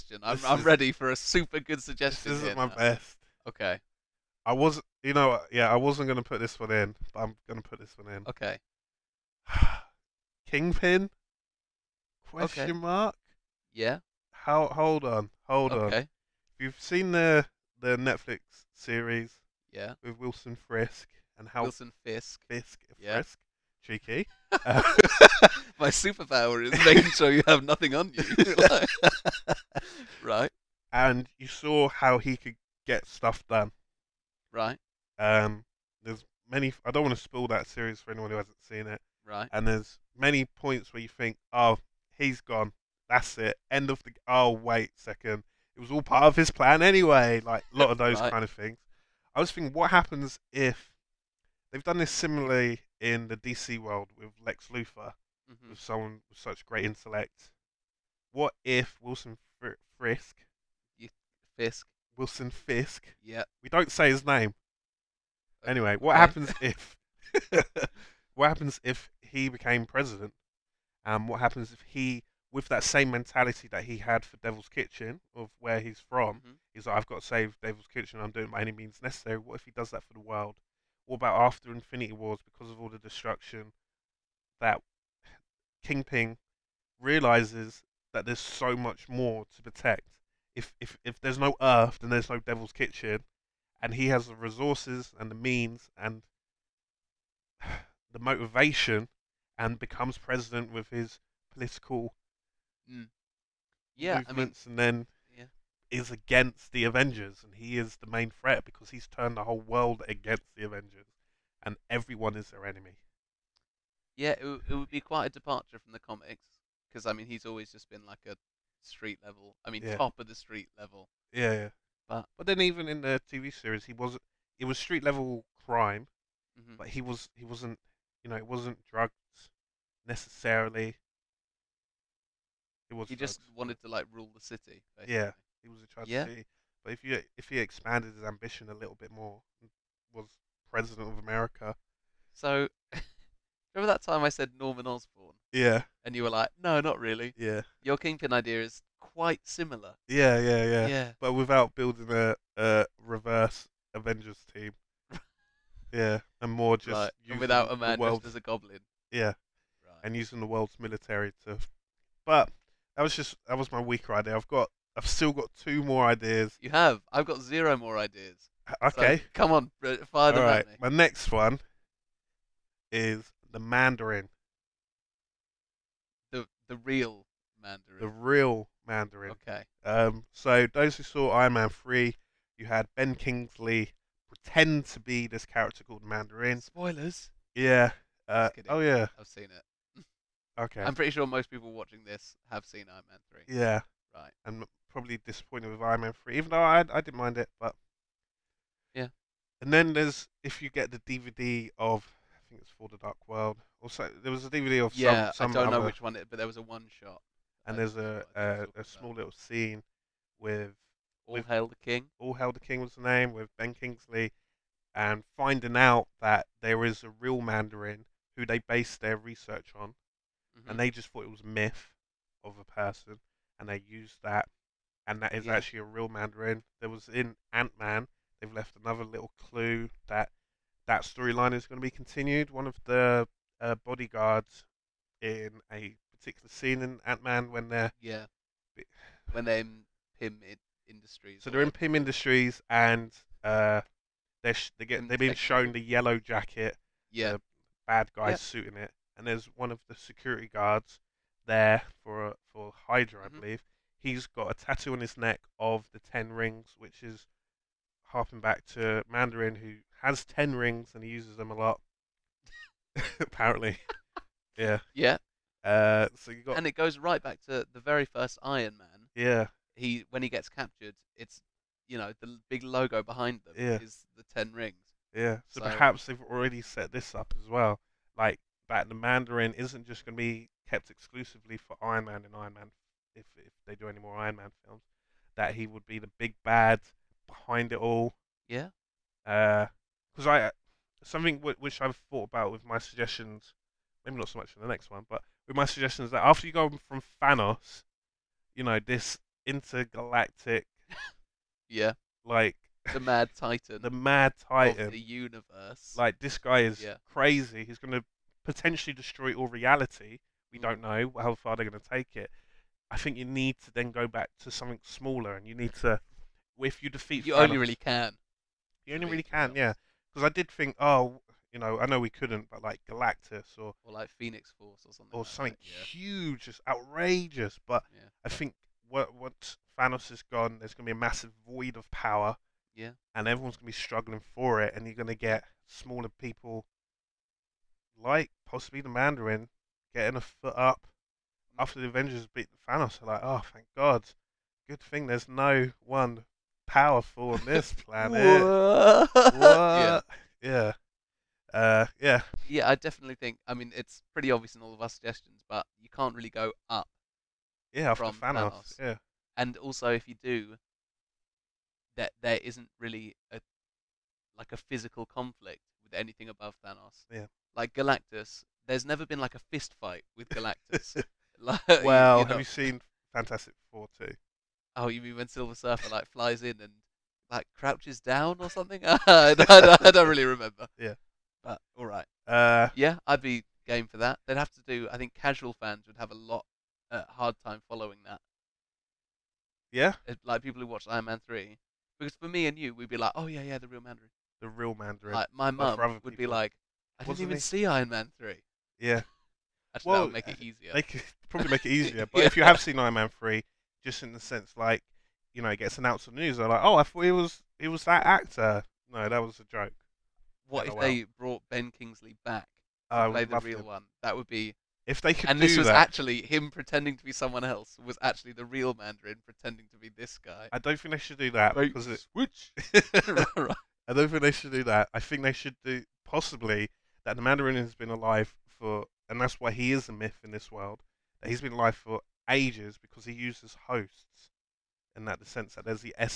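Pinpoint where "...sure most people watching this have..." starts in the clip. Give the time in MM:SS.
03:11.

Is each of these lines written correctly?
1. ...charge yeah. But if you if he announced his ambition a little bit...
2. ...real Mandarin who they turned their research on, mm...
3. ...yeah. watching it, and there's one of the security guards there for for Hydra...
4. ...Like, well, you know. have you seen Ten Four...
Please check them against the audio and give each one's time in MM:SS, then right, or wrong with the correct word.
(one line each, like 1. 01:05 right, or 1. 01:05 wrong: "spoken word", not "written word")
1. 02:15 wrong: "expanded", not "announced"
2. 03:37 wrong: "based", not "turned"
3. 04:08 wrong: "suiting", not "watching"
4. 06:11 wrong: "Fantastic", not "Ten".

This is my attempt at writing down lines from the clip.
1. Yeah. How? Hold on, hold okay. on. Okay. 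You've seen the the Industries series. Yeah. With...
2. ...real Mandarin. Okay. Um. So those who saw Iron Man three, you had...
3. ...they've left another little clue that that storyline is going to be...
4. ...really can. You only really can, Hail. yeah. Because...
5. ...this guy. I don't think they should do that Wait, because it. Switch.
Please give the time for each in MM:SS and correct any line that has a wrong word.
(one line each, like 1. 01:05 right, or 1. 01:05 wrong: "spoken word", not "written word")
1. 00:13 wrong: "Netflix", not "Industries"
2. 02:58 right
3. 03:48 right
4. 05:17 wrong: "Thanos", not "Hail"
5. 06:59 right.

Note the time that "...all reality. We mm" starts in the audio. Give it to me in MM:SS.
05:09.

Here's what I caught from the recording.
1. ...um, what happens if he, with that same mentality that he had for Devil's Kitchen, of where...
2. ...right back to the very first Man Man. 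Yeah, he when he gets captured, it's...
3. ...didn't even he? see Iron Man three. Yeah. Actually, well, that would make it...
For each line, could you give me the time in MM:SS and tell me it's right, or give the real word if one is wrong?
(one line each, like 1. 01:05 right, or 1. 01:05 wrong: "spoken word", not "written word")
1. 01:11 right
2. 04:26 wrong: "Iron", not "Man"
3. 06:37 right.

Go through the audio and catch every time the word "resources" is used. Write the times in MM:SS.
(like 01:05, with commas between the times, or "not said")
01:34.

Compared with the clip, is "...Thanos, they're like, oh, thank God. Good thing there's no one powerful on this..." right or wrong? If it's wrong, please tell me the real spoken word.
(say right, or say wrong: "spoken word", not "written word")
right.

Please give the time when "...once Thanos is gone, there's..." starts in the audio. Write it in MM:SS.
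05:29.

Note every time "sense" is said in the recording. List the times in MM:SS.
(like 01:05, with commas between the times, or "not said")
06:44, 07:15.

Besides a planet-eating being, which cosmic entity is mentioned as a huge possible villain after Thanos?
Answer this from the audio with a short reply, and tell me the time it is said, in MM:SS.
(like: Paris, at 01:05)
Phoenix Force, at 05:24.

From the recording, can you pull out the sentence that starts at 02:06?
but he was he wasn't you know it wasn't drugs necessarily.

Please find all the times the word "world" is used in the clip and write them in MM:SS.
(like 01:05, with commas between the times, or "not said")
00:53, 01:20, 01:49, 02:40, 03:23, 07:10.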